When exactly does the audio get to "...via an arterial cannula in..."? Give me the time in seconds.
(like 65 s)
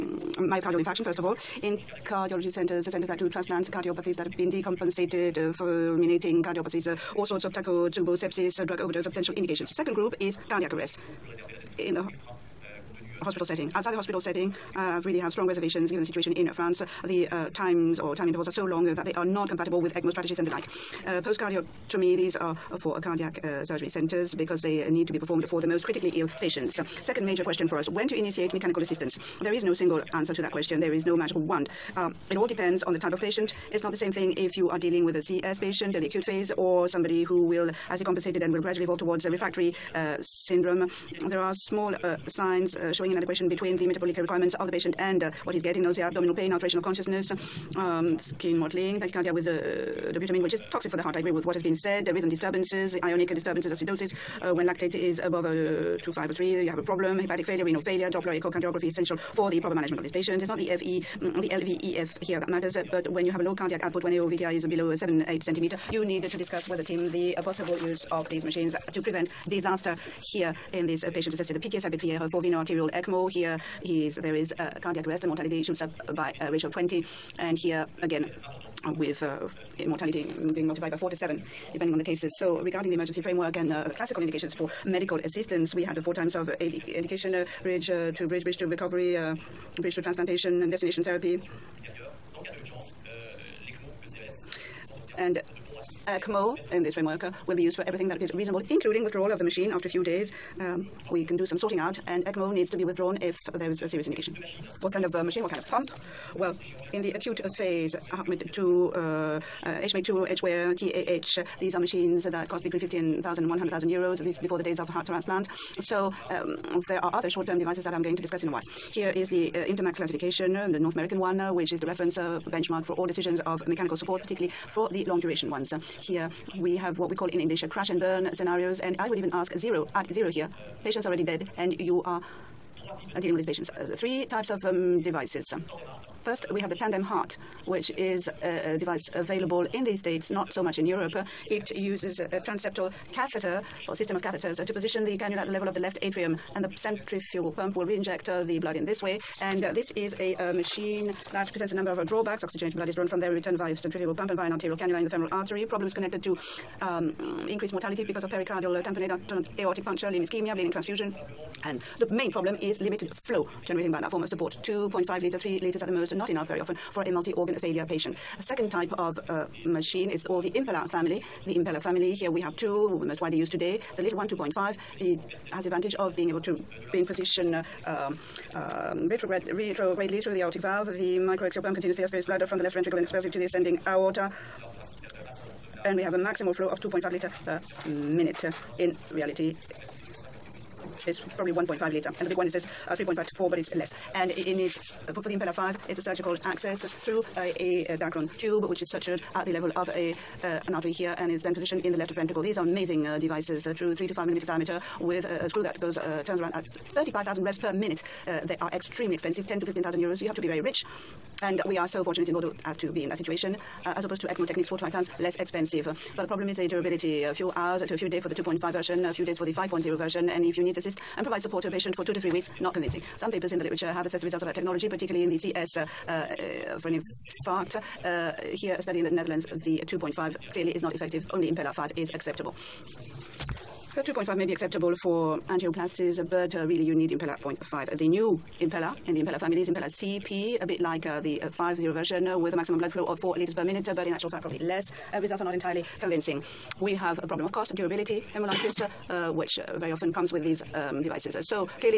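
154 s.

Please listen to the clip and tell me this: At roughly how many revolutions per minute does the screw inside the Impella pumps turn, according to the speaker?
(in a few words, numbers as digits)
35,000.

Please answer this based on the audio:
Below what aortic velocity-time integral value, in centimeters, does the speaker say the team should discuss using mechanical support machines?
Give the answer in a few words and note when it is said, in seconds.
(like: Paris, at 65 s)
7 or 8 cm, at 64 s.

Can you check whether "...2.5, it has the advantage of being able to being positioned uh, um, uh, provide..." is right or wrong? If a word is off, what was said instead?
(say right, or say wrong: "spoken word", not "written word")
wrong: "retrograde", not "provide".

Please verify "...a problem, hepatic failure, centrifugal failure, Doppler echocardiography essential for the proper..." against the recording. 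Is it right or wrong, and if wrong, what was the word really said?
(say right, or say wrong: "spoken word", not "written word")
wrong: "renal", not "centrifugal".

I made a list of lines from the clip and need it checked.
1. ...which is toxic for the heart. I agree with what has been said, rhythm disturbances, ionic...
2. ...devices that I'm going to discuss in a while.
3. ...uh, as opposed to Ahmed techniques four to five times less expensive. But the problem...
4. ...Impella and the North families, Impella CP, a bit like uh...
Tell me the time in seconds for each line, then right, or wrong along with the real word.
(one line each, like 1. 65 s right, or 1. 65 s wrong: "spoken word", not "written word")
1. 50 s right
2. 117 s right
3. 213 s wrong: "ECMO", not "Ahmed"
4. 238 s wrong: "Impella", not "North".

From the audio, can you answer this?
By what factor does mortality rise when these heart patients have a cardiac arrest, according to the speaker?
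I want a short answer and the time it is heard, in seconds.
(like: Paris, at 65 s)
20, at 76 s.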